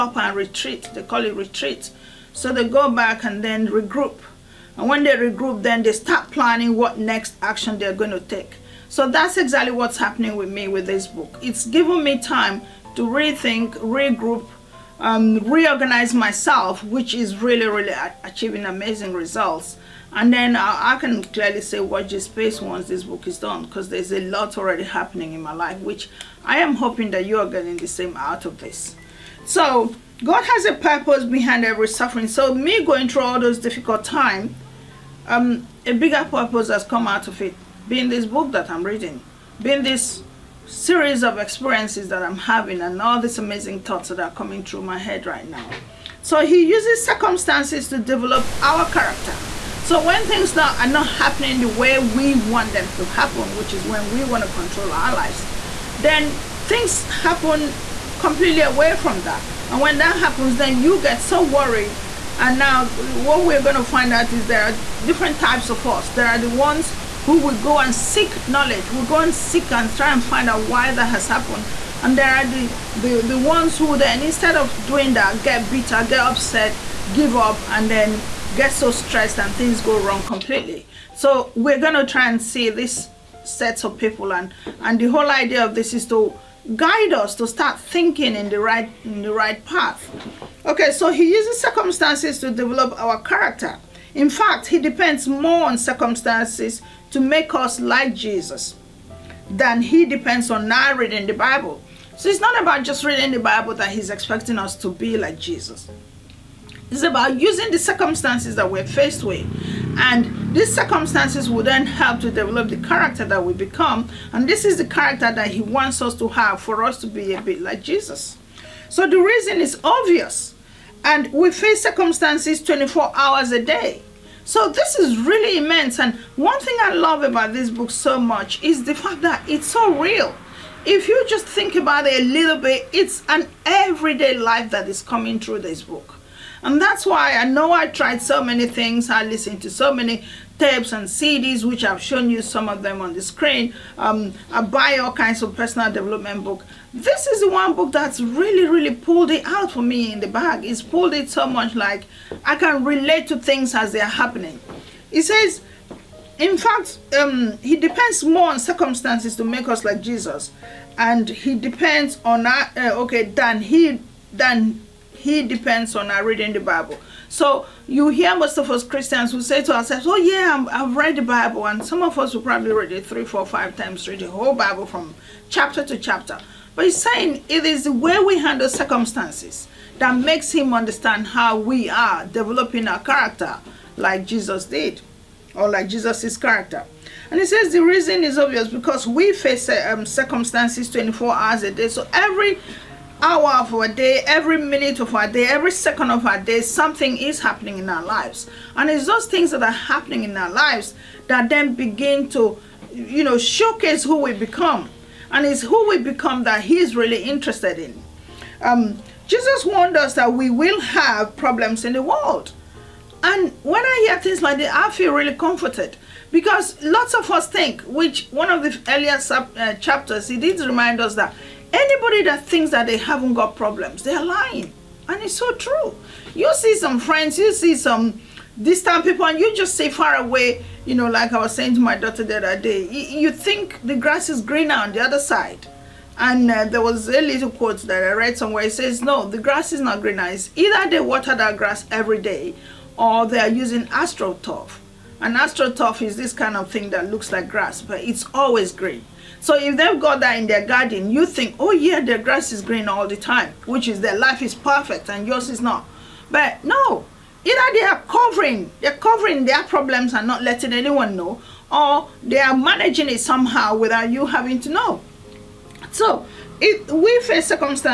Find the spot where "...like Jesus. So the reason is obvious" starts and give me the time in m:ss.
1:57.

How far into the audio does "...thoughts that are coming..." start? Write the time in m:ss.
0:43.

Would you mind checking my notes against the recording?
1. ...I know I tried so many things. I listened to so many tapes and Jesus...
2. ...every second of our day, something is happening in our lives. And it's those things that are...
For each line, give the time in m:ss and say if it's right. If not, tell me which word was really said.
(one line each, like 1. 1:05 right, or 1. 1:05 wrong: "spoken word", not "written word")
1. 2:17 wrong: "CDs", not "Jesus"
2. 3:15 right.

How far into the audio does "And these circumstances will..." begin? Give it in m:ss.
1:49.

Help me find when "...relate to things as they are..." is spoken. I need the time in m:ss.
2:32.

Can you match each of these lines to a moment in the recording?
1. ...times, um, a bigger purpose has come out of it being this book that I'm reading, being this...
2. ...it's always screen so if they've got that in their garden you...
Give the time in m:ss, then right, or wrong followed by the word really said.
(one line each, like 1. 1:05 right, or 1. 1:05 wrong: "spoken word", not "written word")
1. 0:34 right
2. 4:08 wrong: "green", not "screen".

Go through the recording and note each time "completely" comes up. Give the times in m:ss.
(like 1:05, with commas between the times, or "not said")
0:58, 1:20.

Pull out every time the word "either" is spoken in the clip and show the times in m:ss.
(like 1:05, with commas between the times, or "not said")
4:00, 4:17.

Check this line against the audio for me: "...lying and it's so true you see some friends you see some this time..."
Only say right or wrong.
right.